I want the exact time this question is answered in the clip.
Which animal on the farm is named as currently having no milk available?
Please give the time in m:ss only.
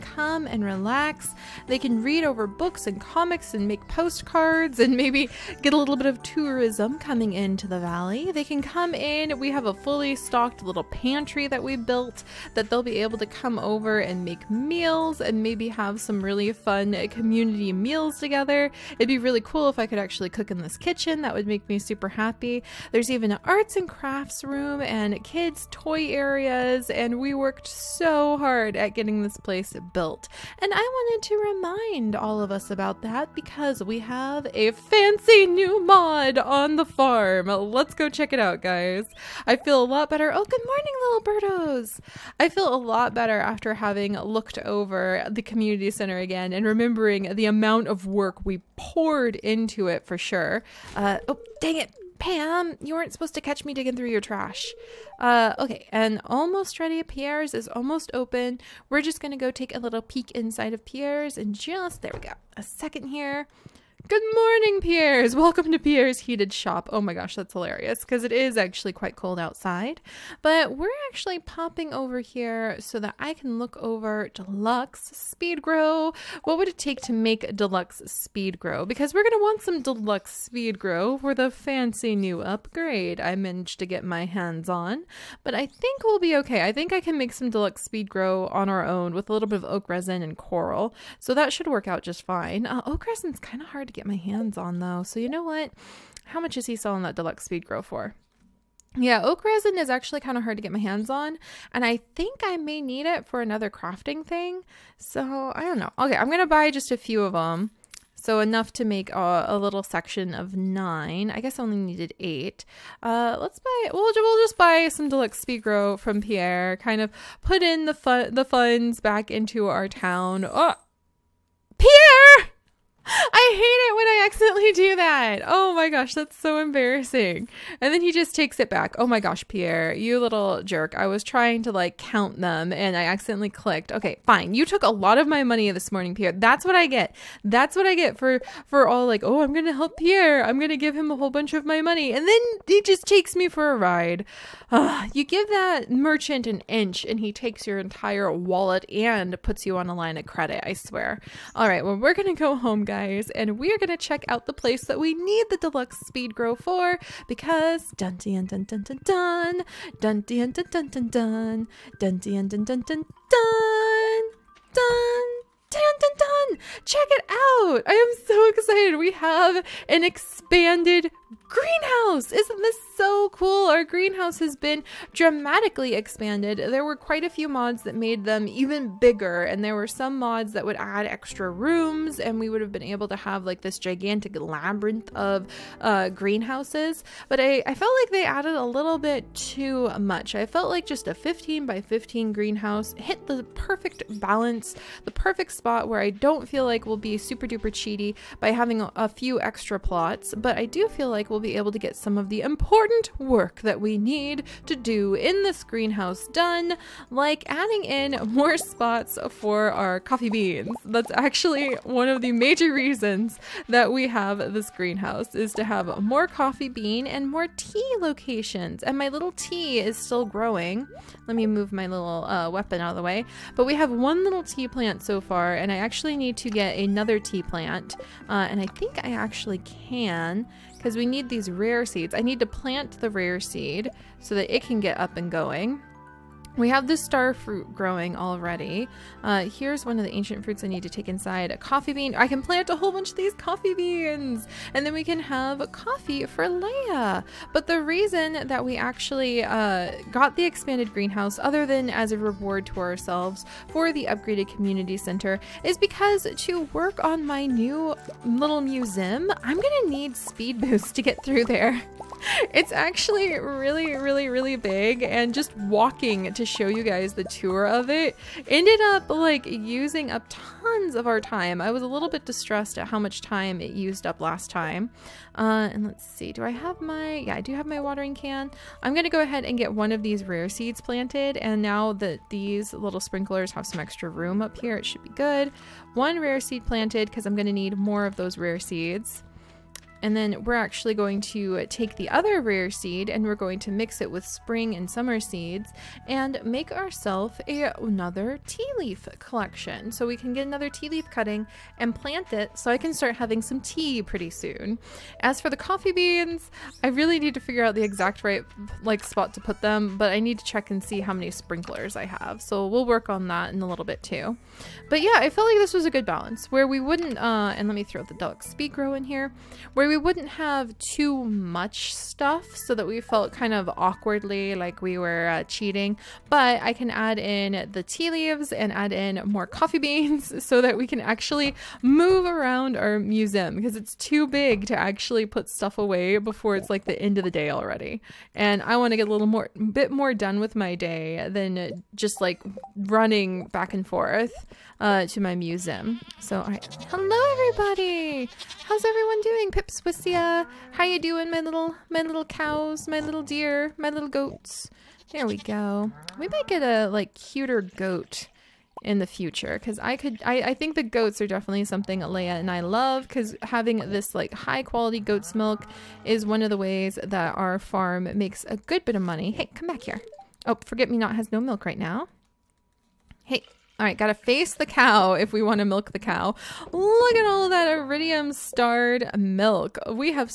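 6:10.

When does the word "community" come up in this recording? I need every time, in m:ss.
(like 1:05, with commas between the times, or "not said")
0:17, 0:45, 4:14.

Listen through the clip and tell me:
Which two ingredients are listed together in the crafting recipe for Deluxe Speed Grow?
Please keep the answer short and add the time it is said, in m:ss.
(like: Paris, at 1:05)
Oak resin and coral, at 1:29.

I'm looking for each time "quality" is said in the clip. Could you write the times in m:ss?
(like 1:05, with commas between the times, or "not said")
6:04.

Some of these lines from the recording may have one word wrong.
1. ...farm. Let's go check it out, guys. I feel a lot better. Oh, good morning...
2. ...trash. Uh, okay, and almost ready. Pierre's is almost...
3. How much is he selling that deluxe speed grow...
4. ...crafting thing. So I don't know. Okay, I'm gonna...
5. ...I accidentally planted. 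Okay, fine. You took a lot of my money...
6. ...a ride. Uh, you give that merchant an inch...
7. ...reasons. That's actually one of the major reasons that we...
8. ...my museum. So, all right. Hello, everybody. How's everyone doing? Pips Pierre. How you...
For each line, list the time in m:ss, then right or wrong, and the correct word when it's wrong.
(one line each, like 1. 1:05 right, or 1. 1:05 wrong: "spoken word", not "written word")
1. 0:36 right
2. 0:54 right
3. 1:36 right
4. 1:43 right
5. 2:12 wrong: "clicked", not "planted"
6. 2:23 right
7. 3:30 wrong: "beans", not "reasons"
8. 5:45 wrong: "Swissia", not "Pierre".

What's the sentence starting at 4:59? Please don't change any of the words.
So we can get another tea leaf cutting and plant it so I can start having some tea pretty soon.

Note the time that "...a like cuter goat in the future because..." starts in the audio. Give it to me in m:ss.
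5:56.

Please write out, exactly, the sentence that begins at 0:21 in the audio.
That would make me super happy.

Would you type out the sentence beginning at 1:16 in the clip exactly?
What would it take to make Deluxe Speed Grow?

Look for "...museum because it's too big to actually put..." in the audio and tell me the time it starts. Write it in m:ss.
5:32.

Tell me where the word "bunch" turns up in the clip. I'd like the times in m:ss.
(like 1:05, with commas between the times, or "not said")
2:21, 4:02.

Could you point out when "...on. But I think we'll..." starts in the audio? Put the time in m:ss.
1:24.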